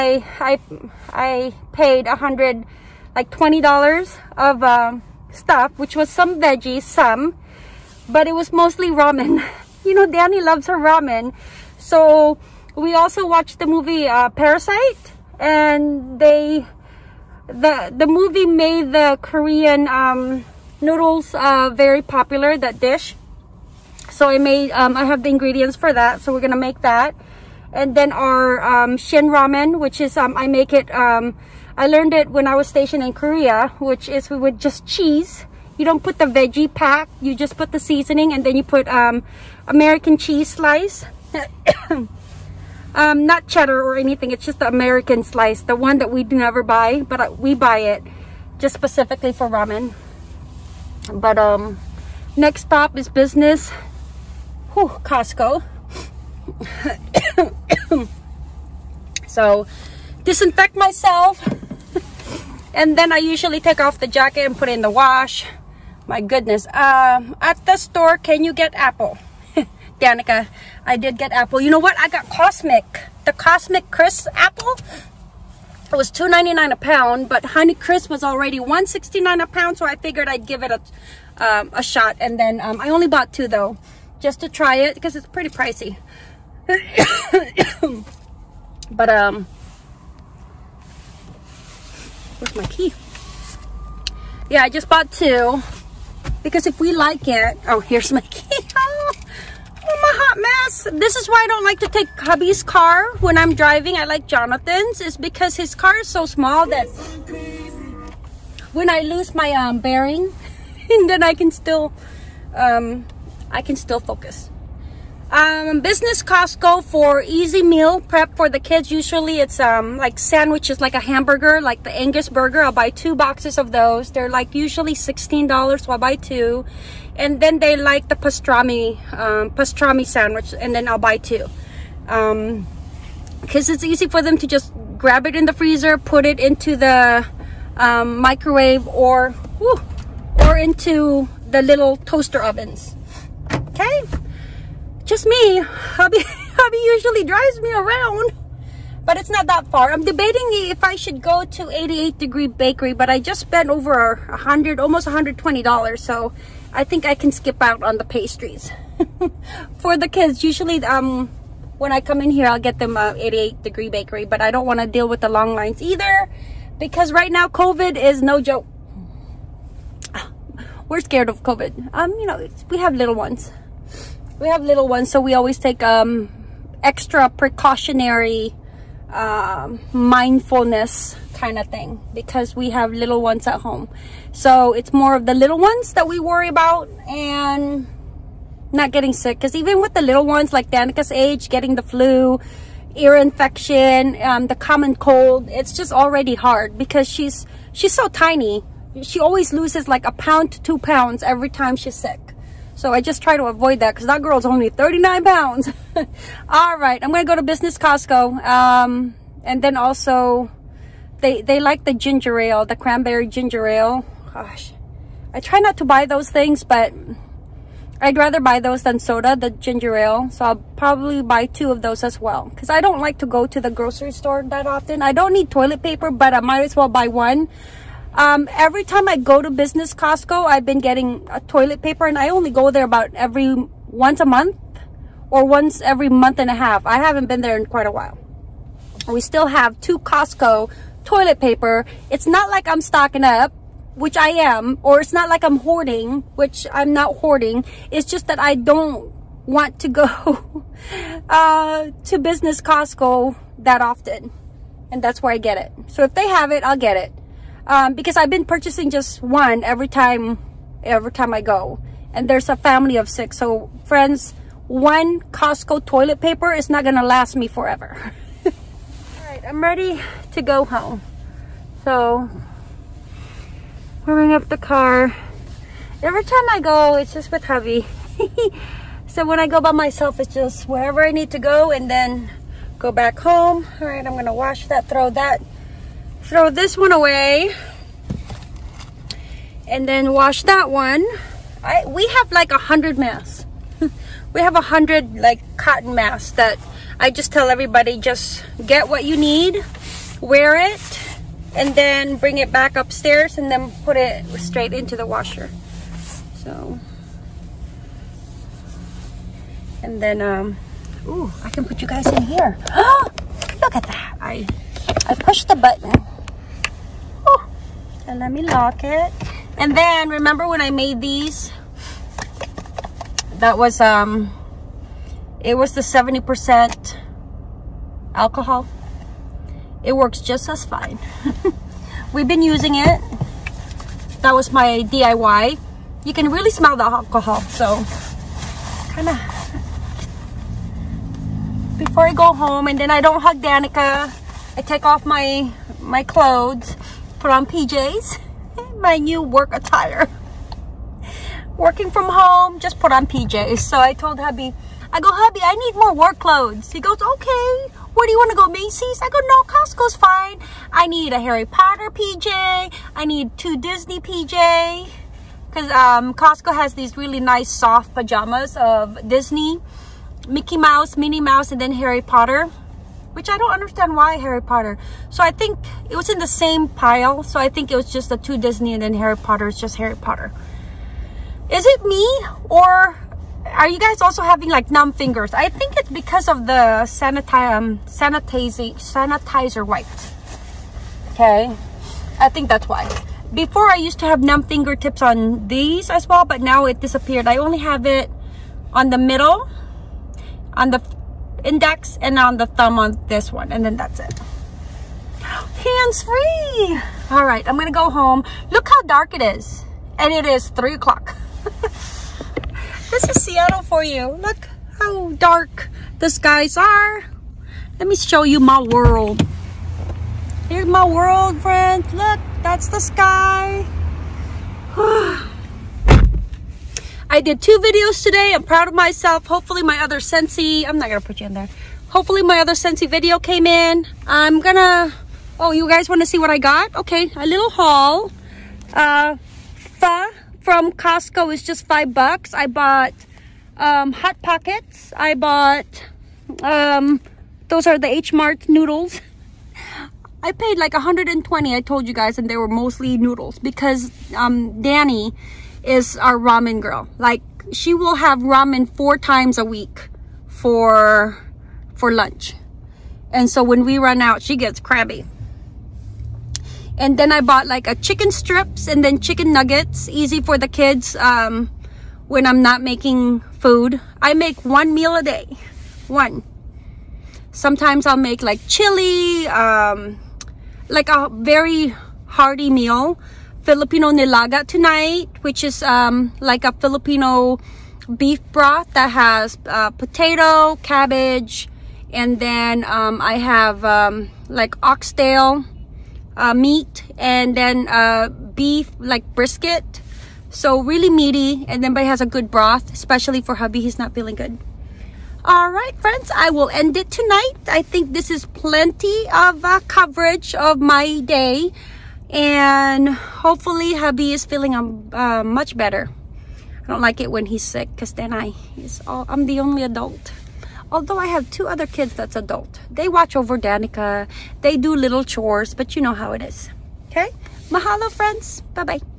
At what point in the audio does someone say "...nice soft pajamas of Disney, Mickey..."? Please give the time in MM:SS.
06:07.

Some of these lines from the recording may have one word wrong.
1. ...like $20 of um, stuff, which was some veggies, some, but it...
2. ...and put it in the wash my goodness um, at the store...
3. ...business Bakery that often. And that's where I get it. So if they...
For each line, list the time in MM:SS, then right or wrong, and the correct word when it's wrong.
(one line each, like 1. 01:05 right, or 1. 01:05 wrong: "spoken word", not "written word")
1. 00:03 right
2. 01:04 right
3. 04:12 wrong: "Costco", not "Bakery".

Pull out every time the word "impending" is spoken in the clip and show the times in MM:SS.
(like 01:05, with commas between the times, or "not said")
not said.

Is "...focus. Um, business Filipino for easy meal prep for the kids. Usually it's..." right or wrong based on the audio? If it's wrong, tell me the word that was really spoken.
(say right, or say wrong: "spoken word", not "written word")
wrong: "Costco", not "Filipino".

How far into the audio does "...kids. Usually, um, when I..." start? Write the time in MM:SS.
02:40.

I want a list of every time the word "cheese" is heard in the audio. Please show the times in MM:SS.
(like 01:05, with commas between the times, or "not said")
00:34, 00:40.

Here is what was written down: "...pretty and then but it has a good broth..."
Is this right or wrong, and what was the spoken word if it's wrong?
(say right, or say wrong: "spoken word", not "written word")
wrong: "meaty", not "pretty".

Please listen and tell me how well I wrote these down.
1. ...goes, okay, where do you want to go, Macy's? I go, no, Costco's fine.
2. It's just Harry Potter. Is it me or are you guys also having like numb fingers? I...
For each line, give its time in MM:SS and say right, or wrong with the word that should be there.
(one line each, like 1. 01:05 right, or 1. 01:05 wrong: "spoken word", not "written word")
1. 05:56 right
2. 06:19 right.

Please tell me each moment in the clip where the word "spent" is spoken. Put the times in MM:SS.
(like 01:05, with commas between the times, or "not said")
02:33.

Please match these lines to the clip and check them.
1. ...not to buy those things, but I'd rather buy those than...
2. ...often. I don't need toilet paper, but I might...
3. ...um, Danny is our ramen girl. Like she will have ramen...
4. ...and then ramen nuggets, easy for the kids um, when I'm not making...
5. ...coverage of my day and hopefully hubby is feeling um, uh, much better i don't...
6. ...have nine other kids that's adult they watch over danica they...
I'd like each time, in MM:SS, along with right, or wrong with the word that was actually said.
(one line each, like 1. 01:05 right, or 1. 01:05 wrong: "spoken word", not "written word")
1. 03:35 right
2. 03:44 right
3. 07:34 right
4. 07:48 wrong: "chicken", not "ramen"
5. 08:29 right
6. 08:41 wrong: "two", not "nine".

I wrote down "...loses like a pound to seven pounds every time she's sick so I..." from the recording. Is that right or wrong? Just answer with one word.
wrong.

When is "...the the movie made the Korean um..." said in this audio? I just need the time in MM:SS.
00:17.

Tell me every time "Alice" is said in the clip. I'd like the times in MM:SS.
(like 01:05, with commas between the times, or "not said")
not said.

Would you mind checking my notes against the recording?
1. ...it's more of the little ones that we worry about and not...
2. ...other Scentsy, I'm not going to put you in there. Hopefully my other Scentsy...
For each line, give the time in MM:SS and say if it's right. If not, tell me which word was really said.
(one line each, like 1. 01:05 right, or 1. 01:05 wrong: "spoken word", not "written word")
1. 03:04 right
2. 07:09 right.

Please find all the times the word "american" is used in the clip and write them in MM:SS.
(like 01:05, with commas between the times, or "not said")
00:39, 00:44.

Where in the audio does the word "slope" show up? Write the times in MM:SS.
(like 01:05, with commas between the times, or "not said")
not said.